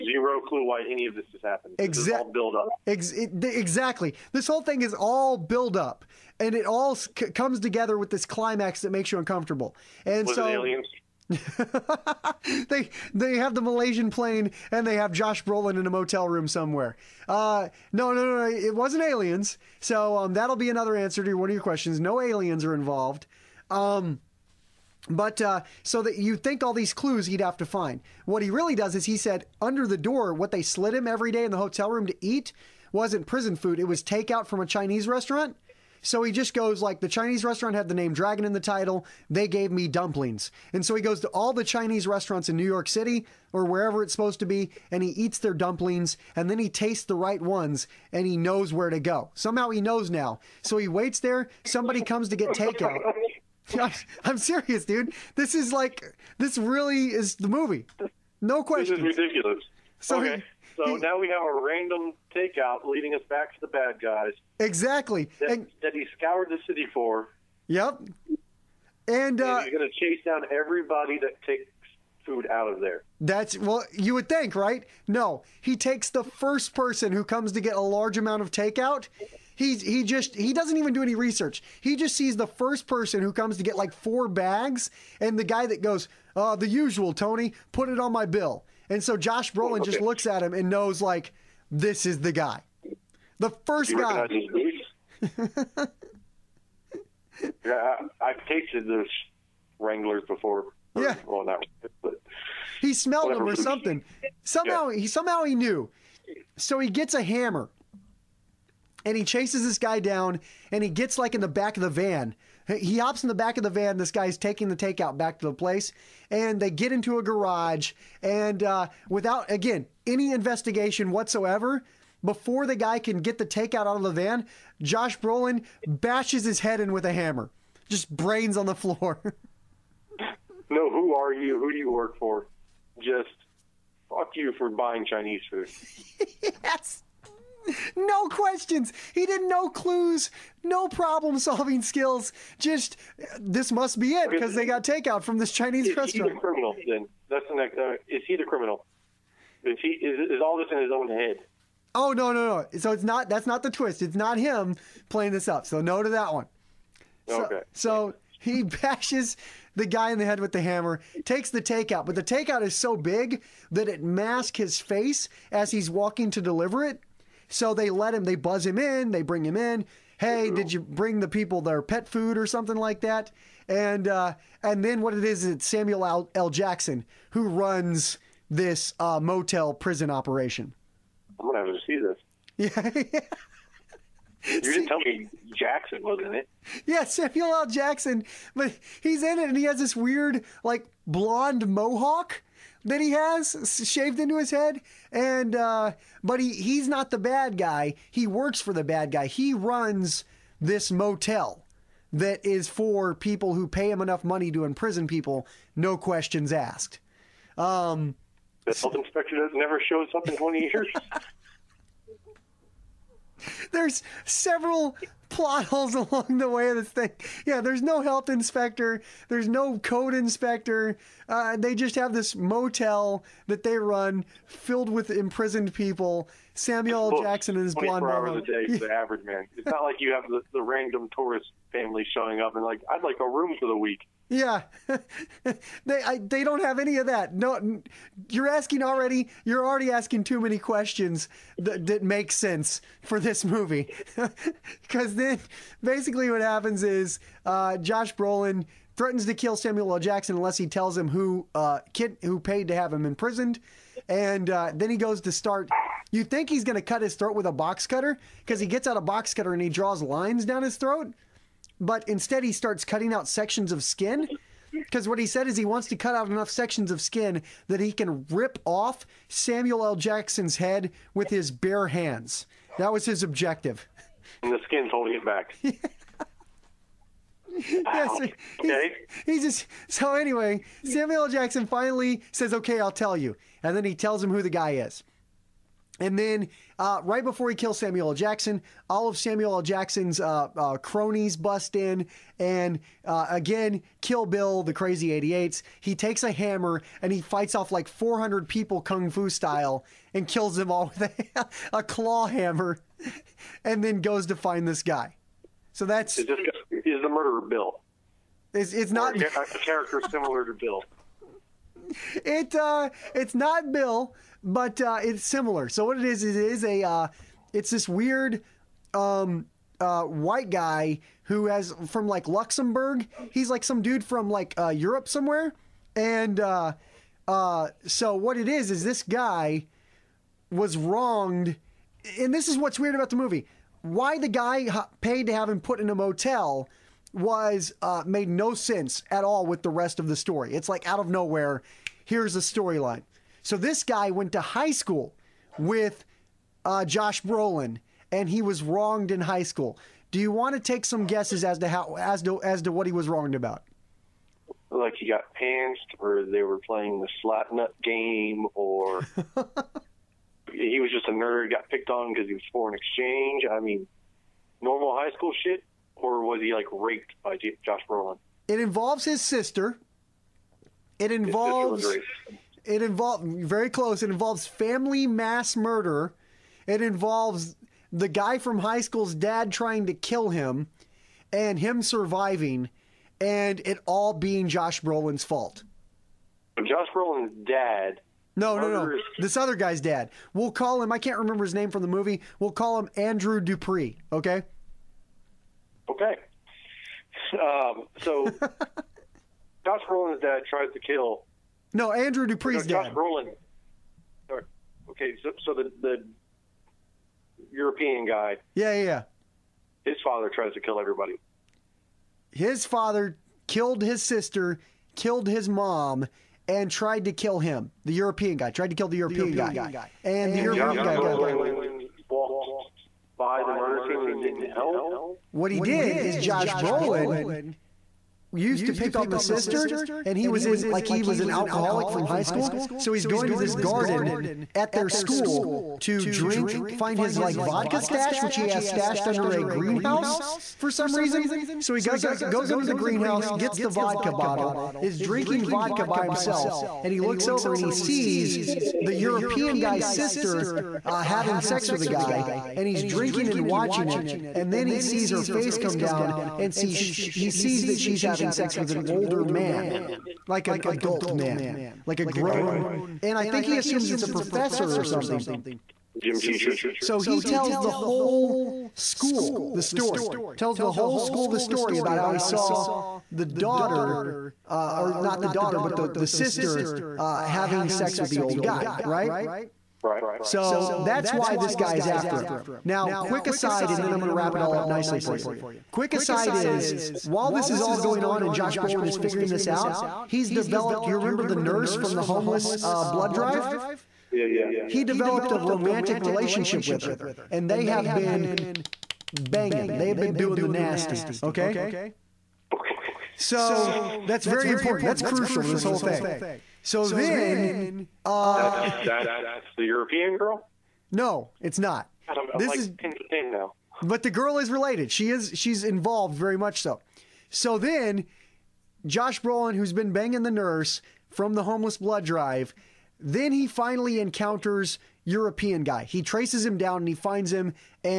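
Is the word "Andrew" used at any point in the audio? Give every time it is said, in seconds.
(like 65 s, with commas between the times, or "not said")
392 s, 401 s.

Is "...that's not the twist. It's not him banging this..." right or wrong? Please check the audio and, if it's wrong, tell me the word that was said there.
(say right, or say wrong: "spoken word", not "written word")
wrong: "playing", not "banging".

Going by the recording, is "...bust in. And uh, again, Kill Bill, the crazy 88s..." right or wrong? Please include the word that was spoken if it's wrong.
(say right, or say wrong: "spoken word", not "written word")
right.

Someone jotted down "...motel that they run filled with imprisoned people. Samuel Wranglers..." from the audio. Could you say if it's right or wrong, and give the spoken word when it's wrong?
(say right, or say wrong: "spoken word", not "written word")
wrong: "Jackson", not "Wranglers".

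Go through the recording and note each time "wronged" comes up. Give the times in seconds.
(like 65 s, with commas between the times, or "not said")
330 s, 348 s, 353 s.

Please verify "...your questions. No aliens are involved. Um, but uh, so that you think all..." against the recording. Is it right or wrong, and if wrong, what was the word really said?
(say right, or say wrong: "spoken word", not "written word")
right.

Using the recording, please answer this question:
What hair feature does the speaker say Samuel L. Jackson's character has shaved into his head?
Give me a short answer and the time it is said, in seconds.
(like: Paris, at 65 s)
Blonde mohawk, at 191 s.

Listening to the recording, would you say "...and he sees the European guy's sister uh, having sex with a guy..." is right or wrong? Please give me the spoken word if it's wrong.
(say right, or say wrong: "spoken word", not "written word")
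right.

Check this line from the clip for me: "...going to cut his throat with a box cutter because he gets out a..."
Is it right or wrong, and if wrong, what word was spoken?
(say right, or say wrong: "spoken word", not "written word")
right.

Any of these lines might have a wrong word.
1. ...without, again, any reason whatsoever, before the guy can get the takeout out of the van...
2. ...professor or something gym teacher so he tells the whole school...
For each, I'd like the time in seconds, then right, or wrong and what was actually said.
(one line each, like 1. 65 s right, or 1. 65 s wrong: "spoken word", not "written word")
1. 119 s wrong: "investigation", not "reason"
2. 464 s right.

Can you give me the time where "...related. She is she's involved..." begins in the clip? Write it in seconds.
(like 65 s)
514 s.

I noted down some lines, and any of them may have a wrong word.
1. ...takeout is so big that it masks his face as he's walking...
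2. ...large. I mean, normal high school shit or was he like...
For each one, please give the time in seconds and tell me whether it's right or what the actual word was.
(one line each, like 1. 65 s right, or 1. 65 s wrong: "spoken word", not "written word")
1. 162 s right
2. 362 s wrong: "exchange", not "large".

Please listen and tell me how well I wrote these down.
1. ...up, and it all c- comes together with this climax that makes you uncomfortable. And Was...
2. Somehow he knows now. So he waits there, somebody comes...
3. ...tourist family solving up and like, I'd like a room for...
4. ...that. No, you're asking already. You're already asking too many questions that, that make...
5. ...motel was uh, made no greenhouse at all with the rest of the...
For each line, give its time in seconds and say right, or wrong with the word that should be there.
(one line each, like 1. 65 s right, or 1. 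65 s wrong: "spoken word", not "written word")
1. 5 s right
2. 49 s right
3. 231 s wrong: "showing", not "solving"
4. 237 s right
5. 335 s wrong: "sense", not "greenhouse".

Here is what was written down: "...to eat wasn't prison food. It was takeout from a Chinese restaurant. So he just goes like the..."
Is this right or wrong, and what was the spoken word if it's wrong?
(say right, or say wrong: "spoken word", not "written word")
right.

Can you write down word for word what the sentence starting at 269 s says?
Jackson's head with his bare hands.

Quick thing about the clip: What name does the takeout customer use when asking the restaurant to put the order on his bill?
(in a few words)
Tony.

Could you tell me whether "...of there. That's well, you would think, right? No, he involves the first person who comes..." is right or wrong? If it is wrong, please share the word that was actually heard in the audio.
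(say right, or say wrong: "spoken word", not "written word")
wrong: "takes", not "involves".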